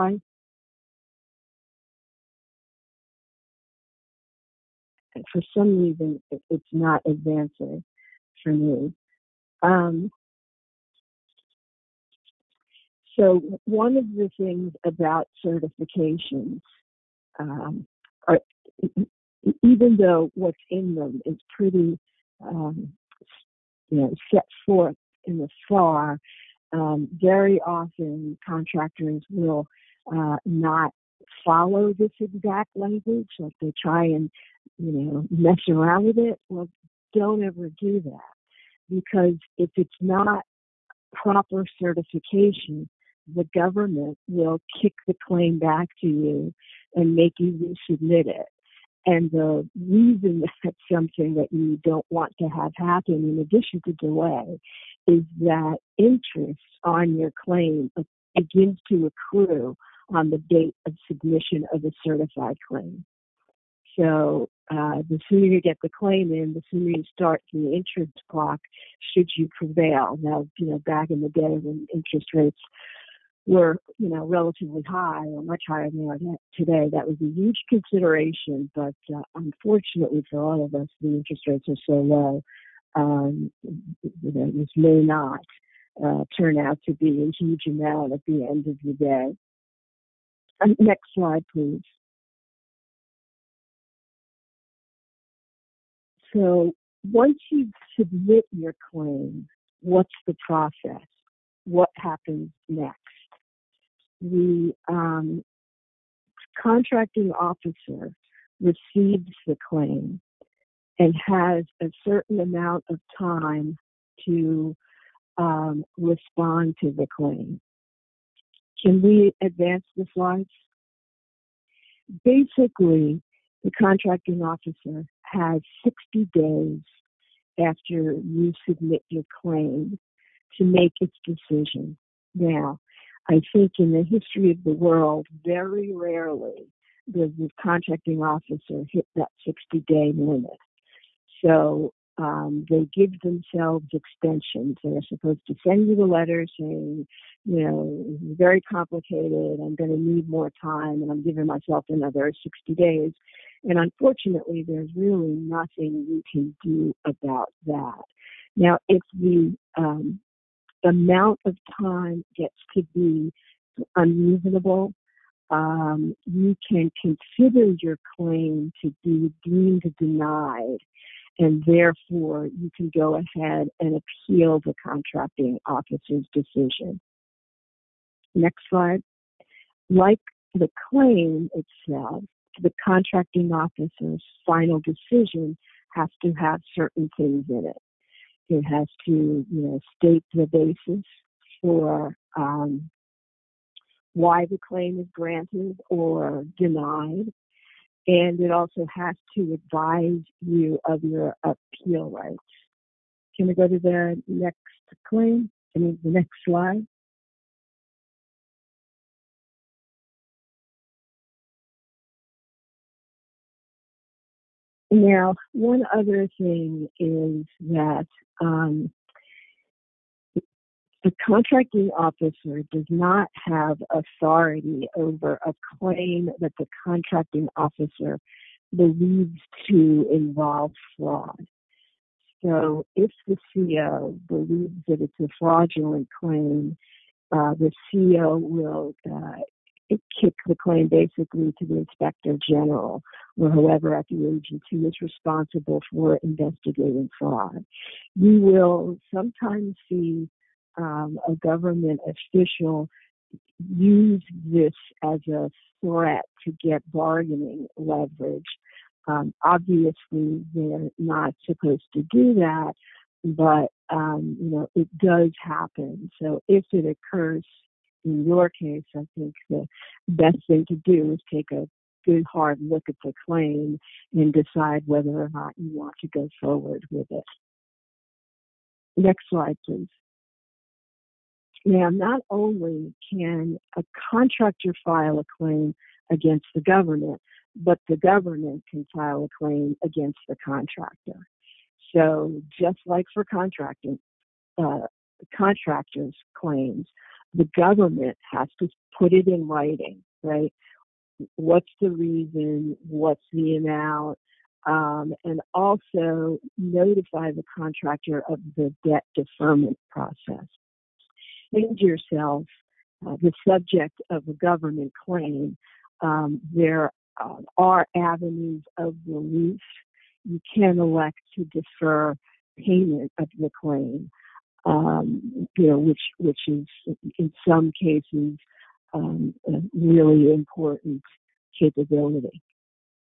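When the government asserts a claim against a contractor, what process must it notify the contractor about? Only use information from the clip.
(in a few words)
Debt deferment process.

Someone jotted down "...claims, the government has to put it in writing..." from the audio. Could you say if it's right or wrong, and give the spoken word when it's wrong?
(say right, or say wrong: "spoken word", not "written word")
right.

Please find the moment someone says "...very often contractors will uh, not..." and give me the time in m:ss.
0:27.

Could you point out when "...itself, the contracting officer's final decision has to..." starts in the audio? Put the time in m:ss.
3:01.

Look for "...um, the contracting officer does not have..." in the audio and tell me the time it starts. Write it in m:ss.
3:38.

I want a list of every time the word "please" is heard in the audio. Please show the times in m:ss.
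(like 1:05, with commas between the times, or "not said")
1:31, 4:39.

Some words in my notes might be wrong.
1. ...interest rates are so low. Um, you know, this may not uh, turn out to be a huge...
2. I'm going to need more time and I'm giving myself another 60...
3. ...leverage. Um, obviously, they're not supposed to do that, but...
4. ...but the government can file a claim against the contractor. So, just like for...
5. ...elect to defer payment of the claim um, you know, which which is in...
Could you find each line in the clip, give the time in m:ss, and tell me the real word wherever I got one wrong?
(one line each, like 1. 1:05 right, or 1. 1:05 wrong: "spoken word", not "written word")
1. 1:21 right
2. 2:29 right
3. 4:17 right
4. 4:47 right
5. 5:20 right.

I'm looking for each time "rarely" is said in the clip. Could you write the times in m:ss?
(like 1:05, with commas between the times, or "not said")
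2:15.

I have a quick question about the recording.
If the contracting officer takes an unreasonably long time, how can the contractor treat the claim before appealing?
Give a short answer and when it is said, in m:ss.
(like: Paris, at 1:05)
Deemed denied, at 2:49.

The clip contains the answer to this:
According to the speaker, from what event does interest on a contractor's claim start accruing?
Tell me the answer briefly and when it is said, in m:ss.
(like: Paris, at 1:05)
Submission of a certified claim, at 1:00.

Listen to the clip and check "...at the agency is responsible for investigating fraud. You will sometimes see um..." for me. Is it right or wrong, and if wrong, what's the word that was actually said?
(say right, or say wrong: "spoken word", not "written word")
right.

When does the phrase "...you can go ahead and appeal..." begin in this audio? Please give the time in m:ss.
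2:52.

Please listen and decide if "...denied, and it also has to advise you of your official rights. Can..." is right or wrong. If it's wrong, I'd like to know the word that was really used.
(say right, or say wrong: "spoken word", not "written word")
wrong: "appeal", not "official".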